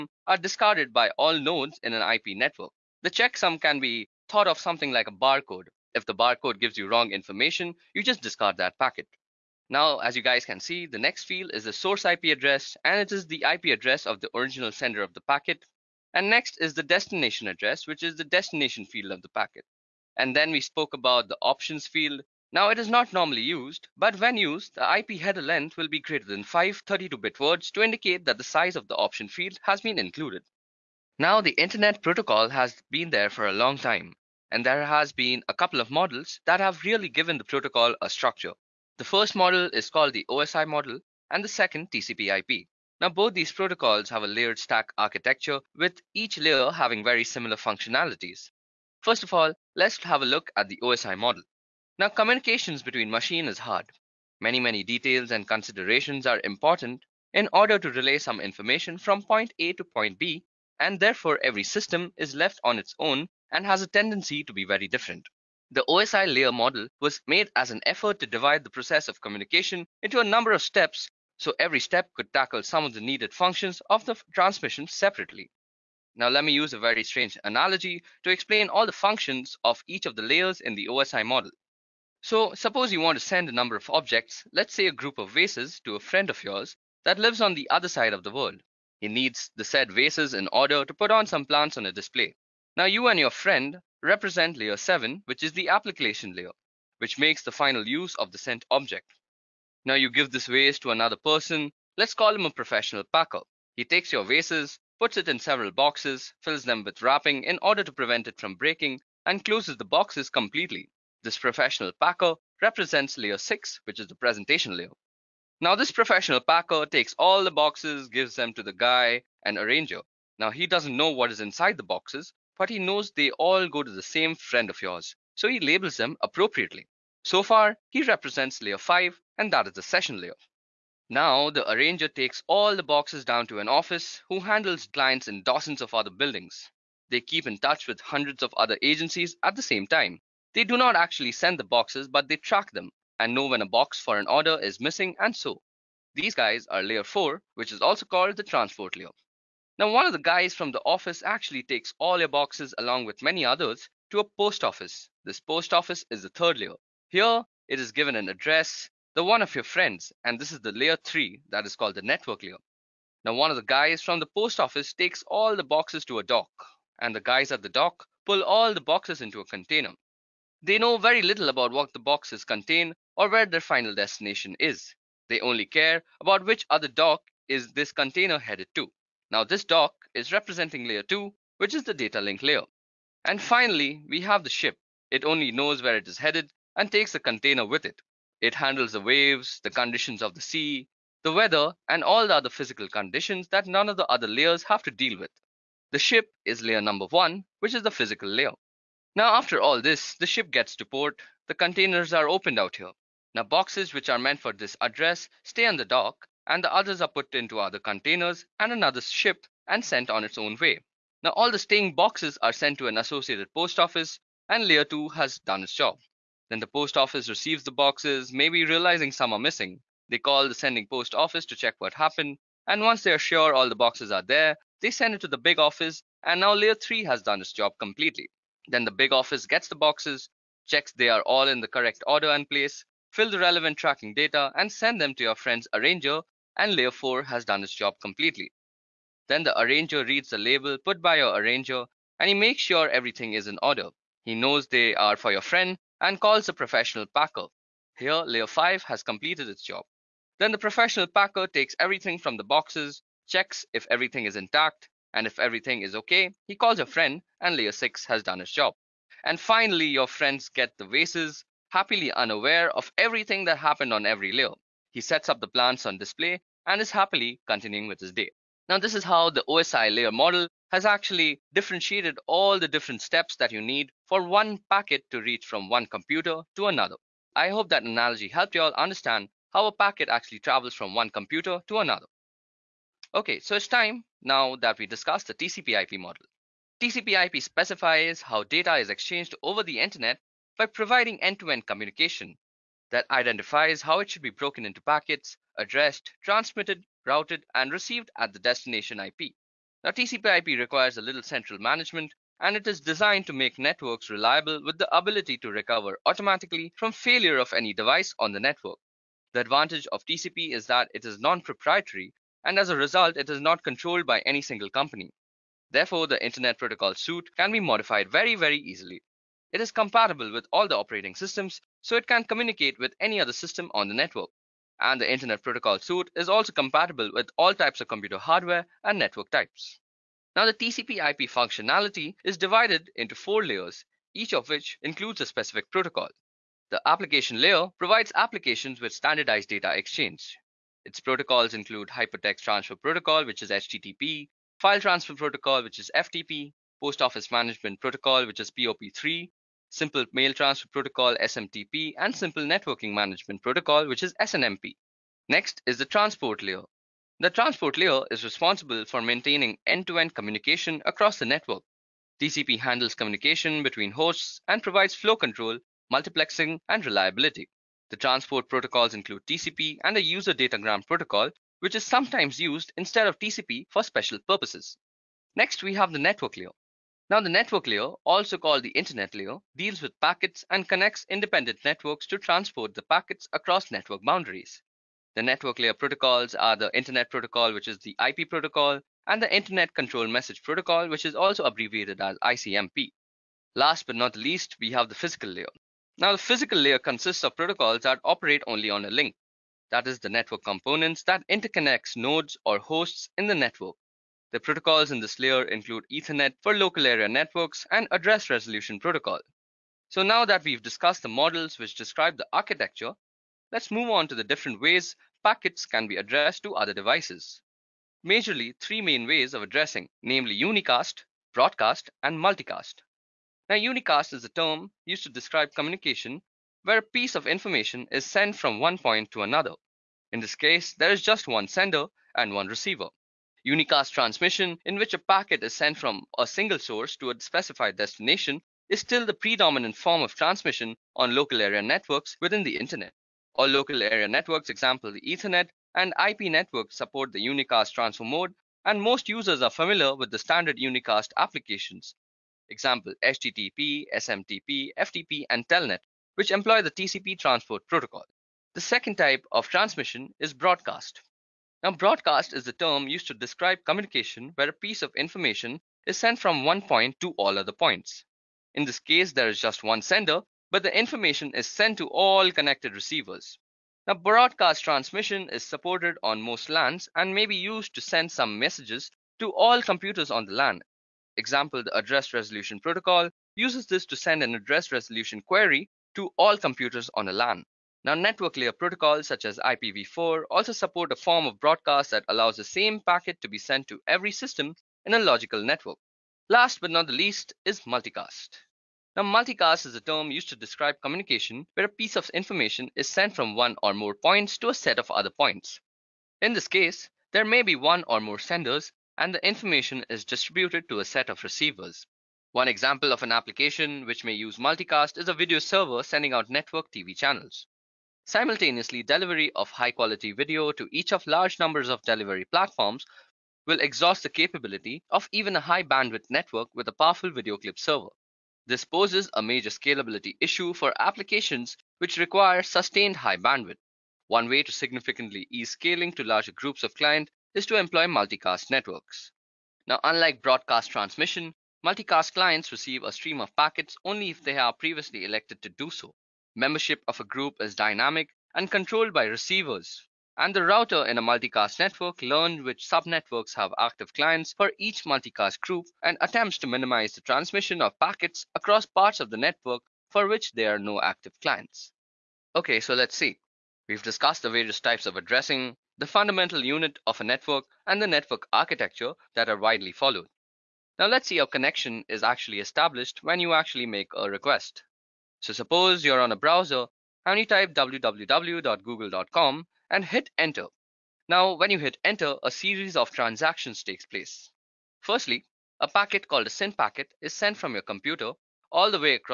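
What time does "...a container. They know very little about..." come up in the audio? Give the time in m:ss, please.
2:49.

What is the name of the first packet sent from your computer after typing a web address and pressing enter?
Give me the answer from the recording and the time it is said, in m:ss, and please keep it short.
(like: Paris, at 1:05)
SYN packet, at 9:46.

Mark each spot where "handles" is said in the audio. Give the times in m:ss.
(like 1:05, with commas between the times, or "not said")
2:14, 3:08, 6:02.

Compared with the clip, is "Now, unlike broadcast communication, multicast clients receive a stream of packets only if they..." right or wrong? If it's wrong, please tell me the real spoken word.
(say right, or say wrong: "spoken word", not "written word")
wrong: "transmission", not "communication".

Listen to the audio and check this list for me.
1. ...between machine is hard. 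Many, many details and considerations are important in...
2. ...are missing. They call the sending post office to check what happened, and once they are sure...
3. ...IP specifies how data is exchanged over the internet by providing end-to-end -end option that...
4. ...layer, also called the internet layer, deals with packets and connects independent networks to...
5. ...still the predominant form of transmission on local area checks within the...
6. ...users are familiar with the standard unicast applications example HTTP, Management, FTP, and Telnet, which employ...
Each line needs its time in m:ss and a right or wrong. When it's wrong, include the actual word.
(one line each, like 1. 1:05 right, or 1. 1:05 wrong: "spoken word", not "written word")
1. 0:52 right
2. 3:39 right
3. 4:47 wrong: "communication", not "option"
4. 6:17 right
5. 7:18 wrong: "networks", not "checks"
6. 7:29 wrong: "SMTP", not "Management".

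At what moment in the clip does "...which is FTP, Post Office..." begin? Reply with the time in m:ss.
5:45.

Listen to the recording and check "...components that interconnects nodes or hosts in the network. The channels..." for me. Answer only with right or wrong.
wrong.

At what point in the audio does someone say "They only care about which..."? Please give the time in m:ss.
2:55.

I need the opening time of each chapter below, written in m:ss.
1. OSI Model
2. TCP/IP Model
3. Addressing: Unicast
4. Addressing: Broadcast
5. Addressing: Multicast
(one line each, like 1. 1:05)
1. 0:30
2. 4:43
3. 6:51
4. 7:37
5. 8:13.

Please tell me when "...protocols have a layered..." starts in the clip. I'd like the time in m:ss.
0:43.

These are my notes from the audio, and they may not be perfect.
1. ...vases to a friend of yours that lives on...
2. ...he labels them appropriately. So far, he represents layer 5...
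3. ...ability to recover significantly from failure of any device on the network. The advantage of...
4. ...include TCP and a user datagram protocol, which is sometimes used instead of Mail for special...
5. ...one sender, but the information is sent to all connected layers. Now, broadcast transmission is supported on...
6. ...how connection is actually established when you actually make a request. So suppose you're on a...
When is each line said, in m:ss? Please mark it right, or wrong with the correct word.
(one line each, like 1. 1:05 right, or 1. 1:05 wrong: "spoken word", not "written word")
1. 1:25 right
2. 2:05 right
3. 5:04 wrong: "automatically", not "significantly"
4. 6:08 wrong: "TCP", not "Mail"
5. 7:49 wrong: "receivers", not "layers"
6. 9:31 right.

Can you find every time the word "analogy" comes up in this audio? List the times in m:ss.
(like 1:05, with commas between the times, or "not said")
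1:17, 4:37.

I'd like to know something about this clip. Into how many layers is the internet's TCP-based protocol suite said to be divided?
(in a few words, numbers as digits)
4.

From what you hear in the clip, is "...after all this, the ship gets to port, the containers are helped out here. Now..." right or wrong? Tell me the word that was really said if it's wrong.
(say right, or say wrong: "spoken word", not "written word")
wrong: "opened", not "helped".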